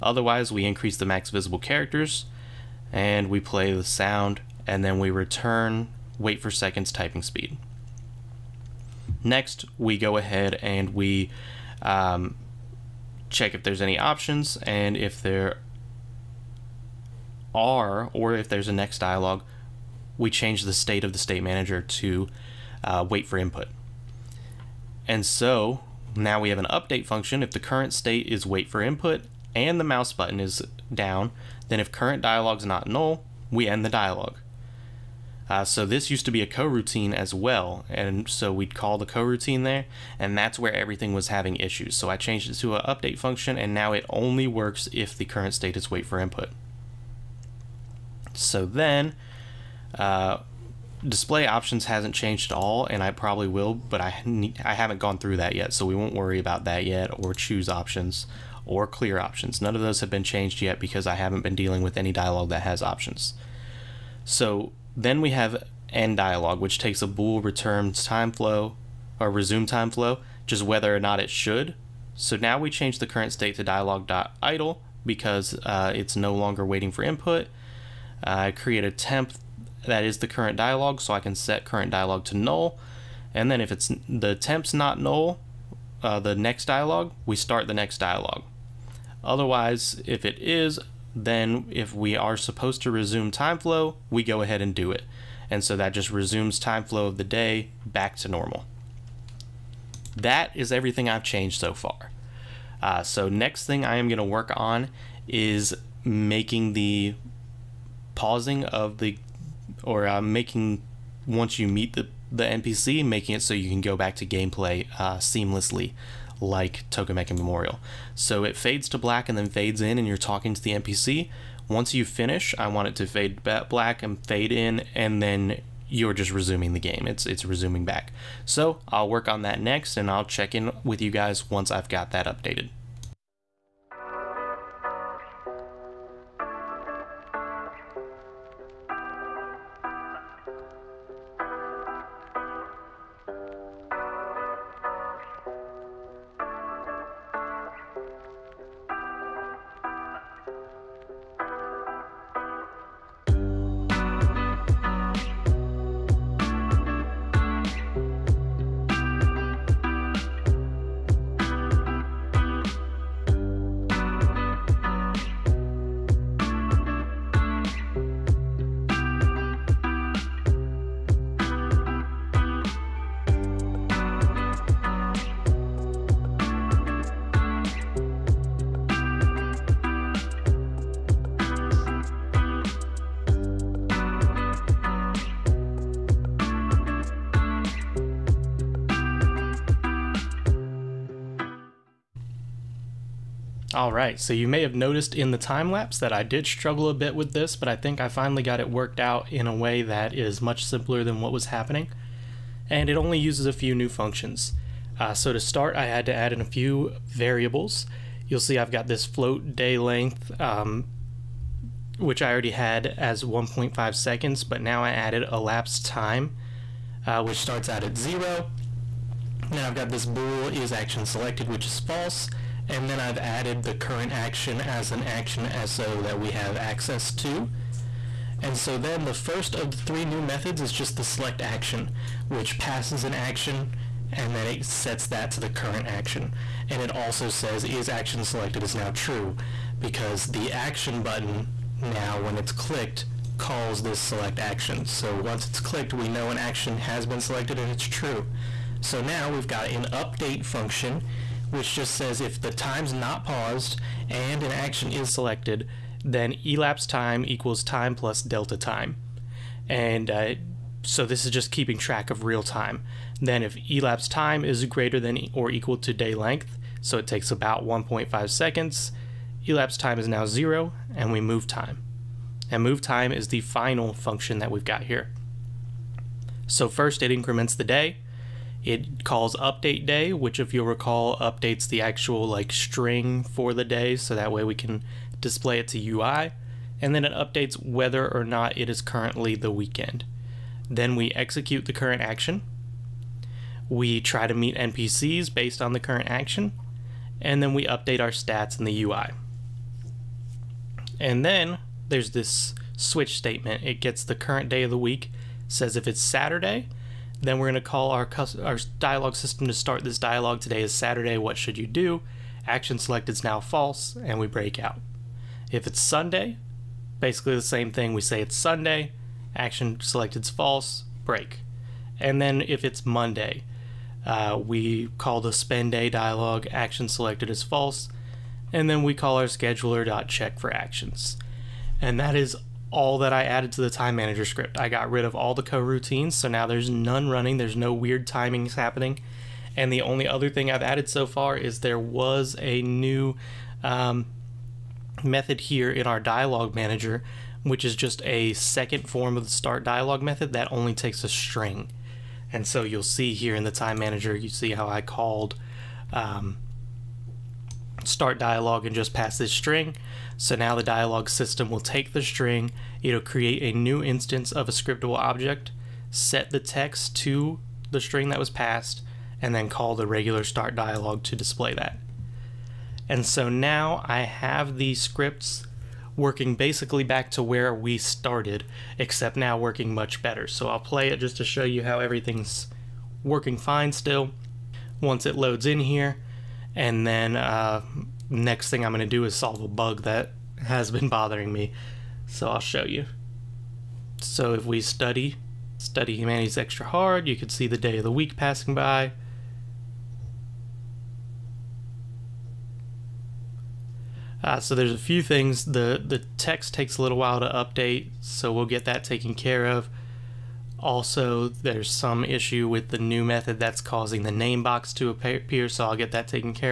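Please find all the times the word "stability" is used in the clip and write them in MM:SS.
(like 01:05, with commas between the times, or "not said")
not said.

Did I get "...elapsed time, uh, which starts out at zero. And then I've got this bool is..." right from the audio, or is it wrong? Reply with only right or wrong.
right.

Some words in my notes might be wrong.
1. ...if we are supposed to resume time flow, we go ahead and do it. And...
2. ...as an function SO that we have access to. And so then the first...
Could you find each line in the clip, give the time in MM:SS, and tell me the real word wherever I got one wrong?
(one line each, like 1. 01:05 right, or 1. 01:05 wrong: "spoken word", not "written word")
1. 01:31 right
2. 03:44 wrong: "action", not "function".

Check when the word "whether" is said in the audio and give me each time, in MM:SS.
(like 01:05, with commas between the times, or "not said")
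01:10, 04:47.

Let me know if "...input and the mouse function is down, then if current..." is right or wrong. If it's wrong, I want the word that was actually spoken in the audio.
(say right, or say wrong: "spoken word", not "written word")
wrong: "button", not "function".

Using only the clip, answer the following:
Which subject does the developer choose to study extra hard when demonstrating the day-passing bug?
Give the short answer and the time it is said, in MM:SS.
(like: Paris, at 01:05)
humanities, at 06:35.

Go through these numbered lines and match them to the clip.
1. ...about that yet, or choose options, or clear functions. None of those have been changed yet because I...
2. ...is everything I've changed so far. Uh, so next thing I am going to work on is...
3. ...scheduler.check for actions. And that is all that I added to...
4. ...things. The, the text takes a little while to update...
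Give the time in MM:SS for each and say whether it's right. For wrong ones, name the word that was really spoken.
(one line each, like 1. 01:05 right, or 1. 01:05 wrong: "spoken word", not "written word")
1. 00:56 wrong: "options", not "functions"
2. 01:40 right
3. 05:29 right
4. 06:45 right.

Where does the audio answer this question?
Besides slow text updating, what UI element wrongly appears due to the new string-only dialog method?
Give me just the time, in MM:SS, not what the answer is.
06:54.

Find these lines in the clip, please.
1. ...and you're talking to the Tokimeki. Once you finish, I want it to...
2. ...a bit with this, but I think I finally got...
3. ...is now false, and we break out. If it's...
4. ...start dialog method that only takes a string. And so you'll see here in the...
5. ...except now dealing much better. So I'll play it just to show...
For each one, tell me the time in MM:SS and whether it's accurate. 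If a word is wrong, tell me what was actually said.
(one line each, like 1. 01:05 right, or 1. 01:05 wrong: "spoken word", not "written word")
1. 01:59 wrong: "NPC", not "Tokimeki"
2. 03:16 right
3. 05:13 right
4. 05:49 right
5. 06:18 wrong: "working", not "dealing".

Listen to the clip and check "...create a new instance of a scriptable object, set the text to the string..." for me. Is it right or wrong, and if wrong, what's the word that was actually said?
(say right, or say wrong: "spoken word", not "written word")
right.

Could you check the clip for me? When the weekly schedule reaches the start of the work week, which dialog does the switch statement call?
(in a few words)
spend day dialog.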